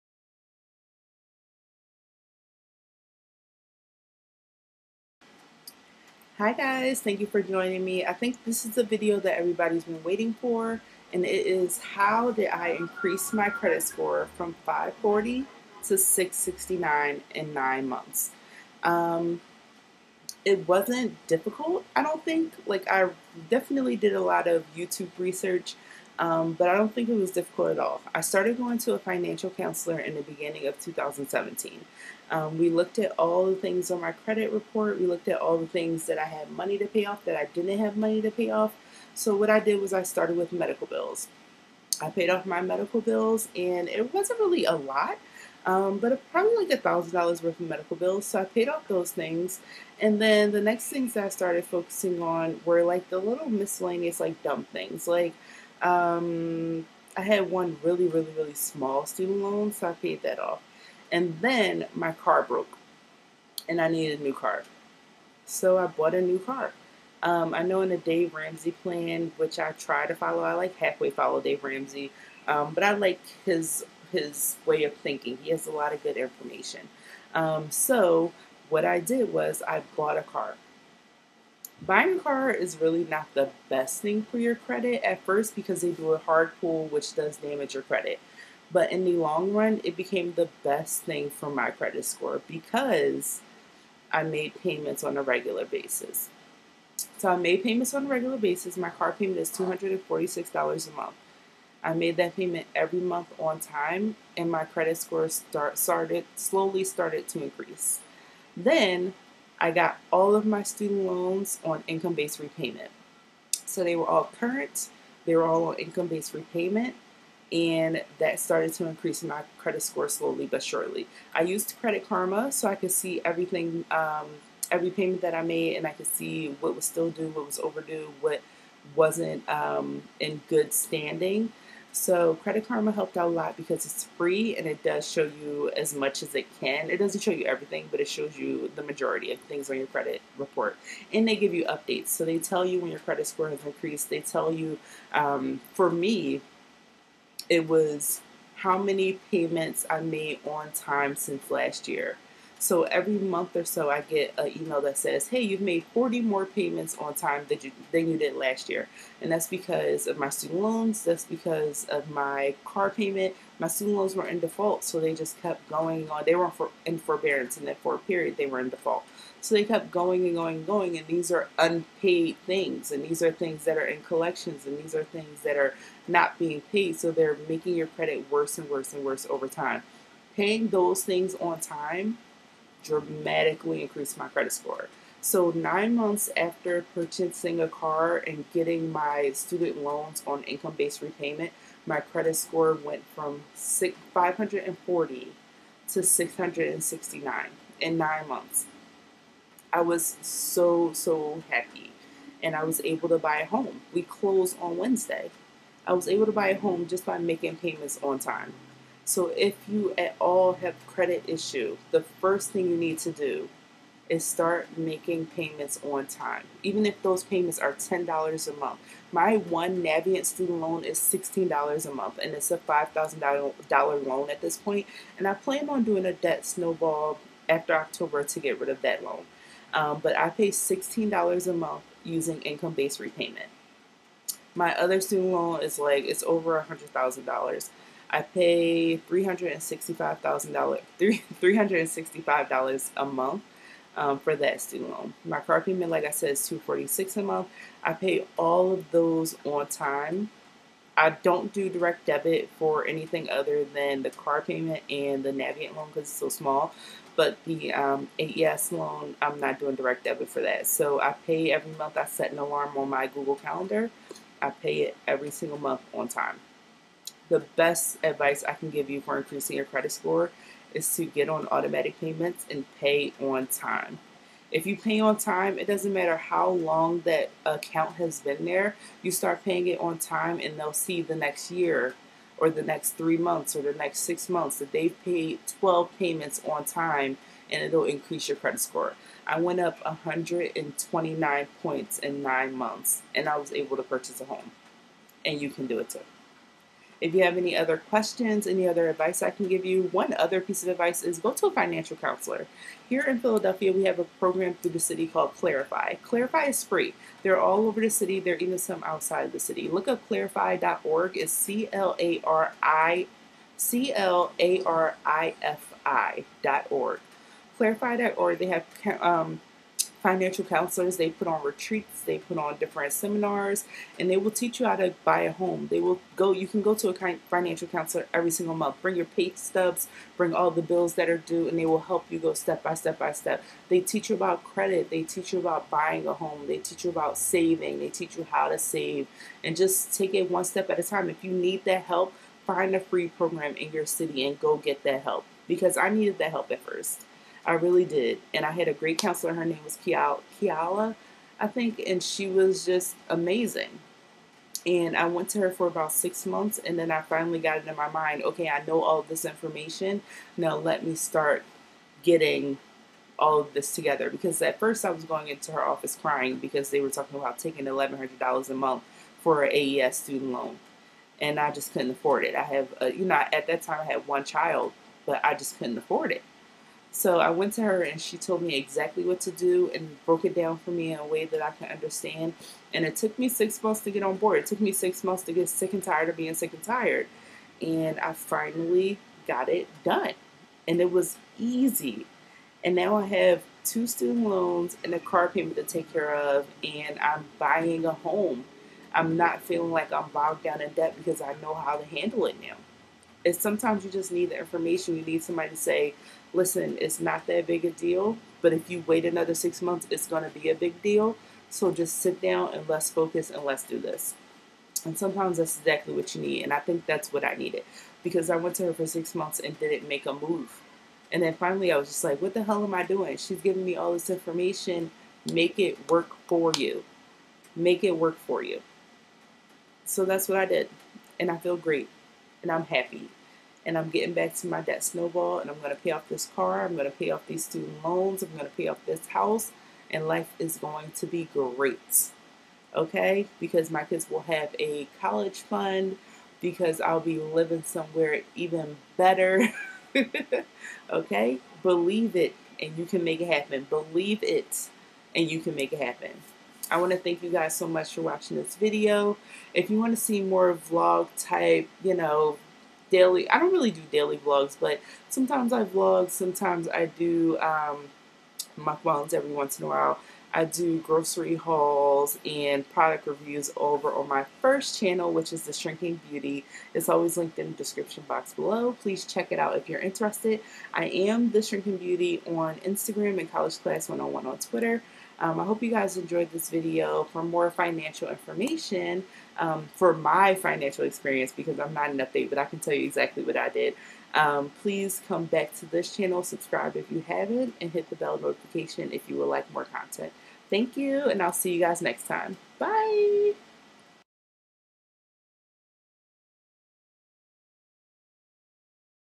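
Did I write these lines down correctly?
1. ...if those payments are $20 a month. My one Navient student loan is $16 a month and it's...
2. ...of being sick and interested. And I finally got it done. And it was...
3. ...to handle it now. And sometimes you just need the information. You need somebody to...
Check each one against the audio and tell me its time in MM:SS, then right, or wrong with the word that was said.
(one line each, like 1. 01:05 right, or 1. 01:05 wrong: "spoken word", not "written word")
1. 03:36 wrong: "10", not "20"
2. 06:26 wrong: "tired", not "interested"
3. 06:41 right.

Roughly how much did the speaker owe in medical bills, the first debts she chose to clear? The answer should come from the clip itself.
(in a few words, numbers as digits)
$1,000.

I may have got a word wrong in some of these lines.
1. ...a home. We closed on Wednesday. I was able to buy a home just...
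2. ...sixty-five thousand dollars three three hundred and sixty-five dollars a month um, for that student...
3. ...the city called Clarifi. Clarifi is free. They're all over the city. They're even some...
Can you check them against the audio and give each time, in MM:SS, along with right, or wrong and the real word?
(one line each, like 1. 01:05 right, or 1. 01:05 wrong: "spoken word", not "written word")
1. 03:23 right
2. 03:59 right
3. 05:04 right.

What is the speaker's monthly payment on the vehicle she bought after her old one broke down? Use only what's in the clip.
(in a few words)
$246.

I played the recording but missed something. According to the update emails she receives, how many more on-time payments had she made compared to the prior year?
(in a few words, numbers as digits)
40.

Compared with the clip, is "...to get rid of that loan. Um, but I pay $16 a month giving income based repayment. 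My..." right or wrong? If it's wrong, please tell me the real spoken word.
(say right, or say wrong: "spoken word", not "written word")
wrong: "using", not "giving".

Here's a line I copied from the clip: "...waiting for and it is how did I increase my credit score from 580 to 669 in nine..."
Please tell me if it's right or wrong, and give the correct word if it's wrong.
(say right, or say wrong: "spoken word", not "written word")
wrong: "540", not "580".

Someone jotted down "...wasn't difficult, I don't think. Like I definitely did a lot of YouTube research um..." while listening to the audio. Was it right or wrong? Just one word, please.
right.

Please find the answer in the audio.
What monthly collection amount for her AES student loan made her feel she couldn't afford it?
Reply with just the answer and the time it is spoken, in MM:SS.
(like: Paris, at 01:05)
$1,100, at 06:07.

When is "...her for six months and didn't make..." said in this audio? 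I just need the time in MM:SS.
06:58.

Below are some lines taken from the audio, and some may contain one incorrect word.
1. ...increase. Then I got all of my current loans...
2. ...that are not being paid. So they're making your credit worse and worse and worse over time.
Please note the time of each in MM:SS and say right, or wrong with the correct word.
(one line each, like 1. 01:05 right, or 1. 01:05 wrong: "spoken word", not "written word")
1. 01:47 wrong: "student", not "current"
2. 02:55 right.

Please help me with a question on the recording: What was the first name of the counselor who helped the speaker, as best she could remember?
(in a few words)
Kiala.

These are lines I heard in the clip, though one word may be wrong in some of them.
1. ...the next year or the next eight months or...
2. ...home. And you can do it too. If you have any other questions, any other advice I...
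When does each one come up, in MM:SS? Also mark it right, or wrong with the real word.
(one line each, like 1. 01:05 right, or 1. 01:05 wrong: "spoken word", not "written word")
1. 04:41 wrong: "three", not "eight"
2. 04:54 right.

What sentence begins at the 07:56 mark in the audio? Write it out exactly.
It's always linked in the description box below.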